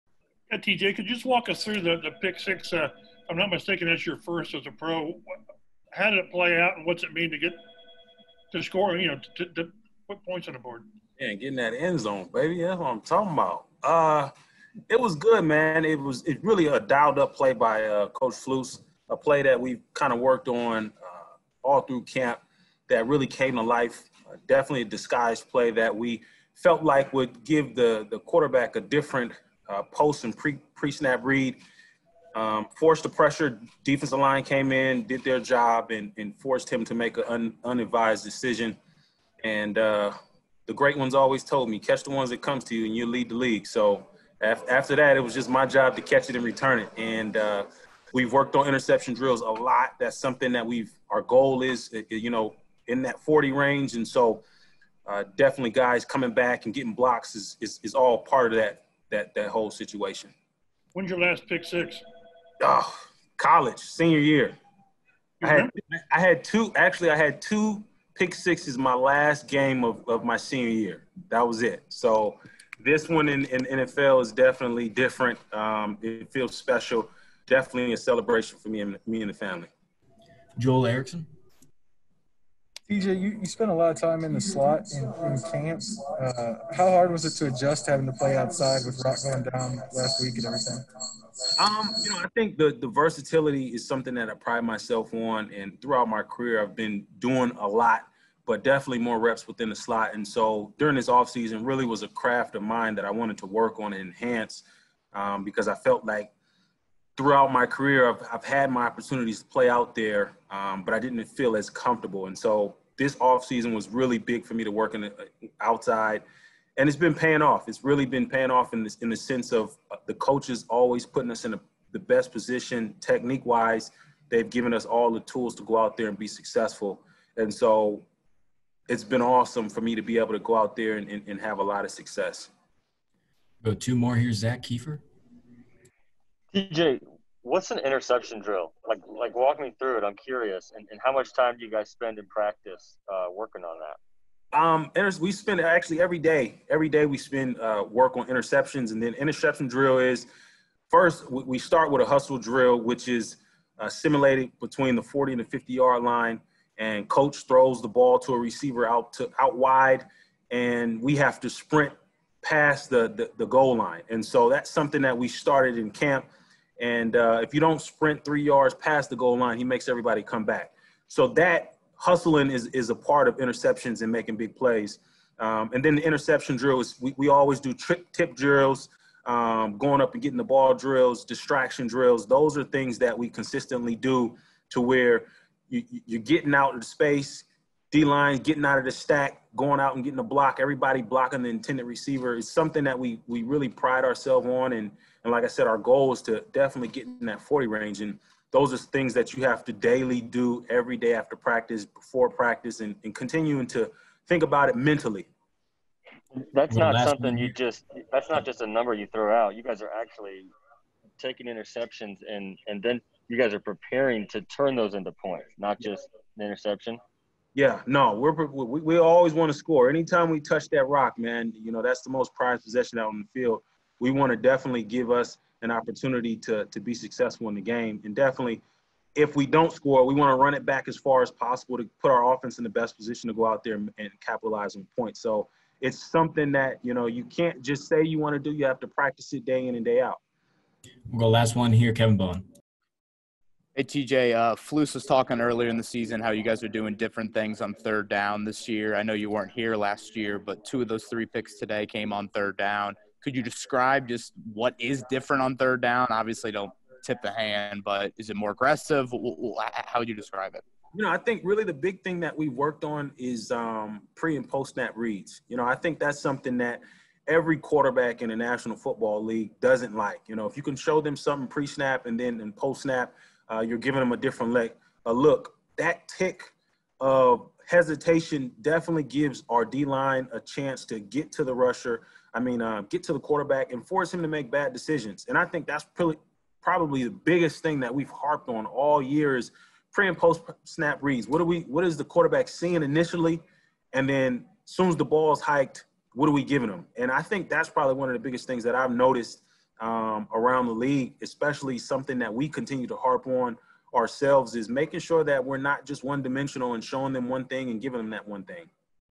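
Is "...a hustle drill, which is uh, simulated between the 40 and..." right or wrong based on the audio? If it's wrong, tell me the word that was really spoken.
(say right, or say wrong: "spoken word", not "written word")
right.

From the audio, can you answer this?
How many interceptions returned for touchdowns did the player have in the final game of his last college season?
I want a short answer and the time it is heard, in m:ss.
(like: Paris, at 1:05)
2, at 1:07.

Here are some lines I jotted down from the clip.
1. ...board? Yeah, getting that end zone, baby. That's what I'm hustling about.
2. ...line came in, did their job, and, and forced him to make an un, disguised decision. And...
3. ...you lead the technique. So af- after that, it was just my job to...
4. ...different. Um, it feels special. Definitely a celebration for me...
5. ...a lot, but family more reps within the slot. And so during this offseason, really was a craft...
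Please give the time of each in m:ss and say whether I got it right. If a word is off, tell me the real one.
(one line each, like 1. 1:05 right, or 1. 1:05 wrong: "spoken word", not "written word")
1. 0:10 wrong: "talking", not "hustling"
2. 0:34 wrong: "unadvised", not "disguised"
3. 0:42 wrong: "league", not "technique"
4. 1:14 right
5. 1:37 wrong: "definitely", not "family".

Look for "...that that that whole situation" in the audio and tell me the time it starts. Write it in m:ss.
0:58.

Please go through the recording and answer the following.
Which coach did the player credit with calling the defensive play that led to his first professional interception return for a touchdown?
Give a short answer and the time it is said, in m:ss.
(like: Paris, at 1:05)
Coach Flus, at 0:18.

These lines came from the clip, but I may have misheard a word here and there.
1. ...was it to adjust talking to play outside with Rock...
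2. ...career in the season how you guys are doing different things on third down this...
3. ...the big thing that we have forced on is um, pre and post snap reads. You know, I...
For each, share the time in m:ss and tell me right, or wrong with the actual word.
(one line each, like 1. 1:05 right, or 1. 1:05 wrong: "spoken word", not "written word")
1. 1:27 wrong: "having", not "talking"
2. 4:05 wrong: "earlier", not "career"
3. 4:21 wrong: "worked", not "forced".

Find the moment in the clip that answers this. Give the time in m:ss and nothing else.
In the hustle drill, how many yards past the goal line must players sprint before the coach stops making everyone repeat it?
2:48.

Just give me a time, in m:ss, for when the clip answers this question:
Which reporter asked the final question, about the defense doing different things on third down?
4:01.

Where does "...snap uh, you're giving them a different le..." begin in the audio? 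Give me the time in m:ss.
4:32.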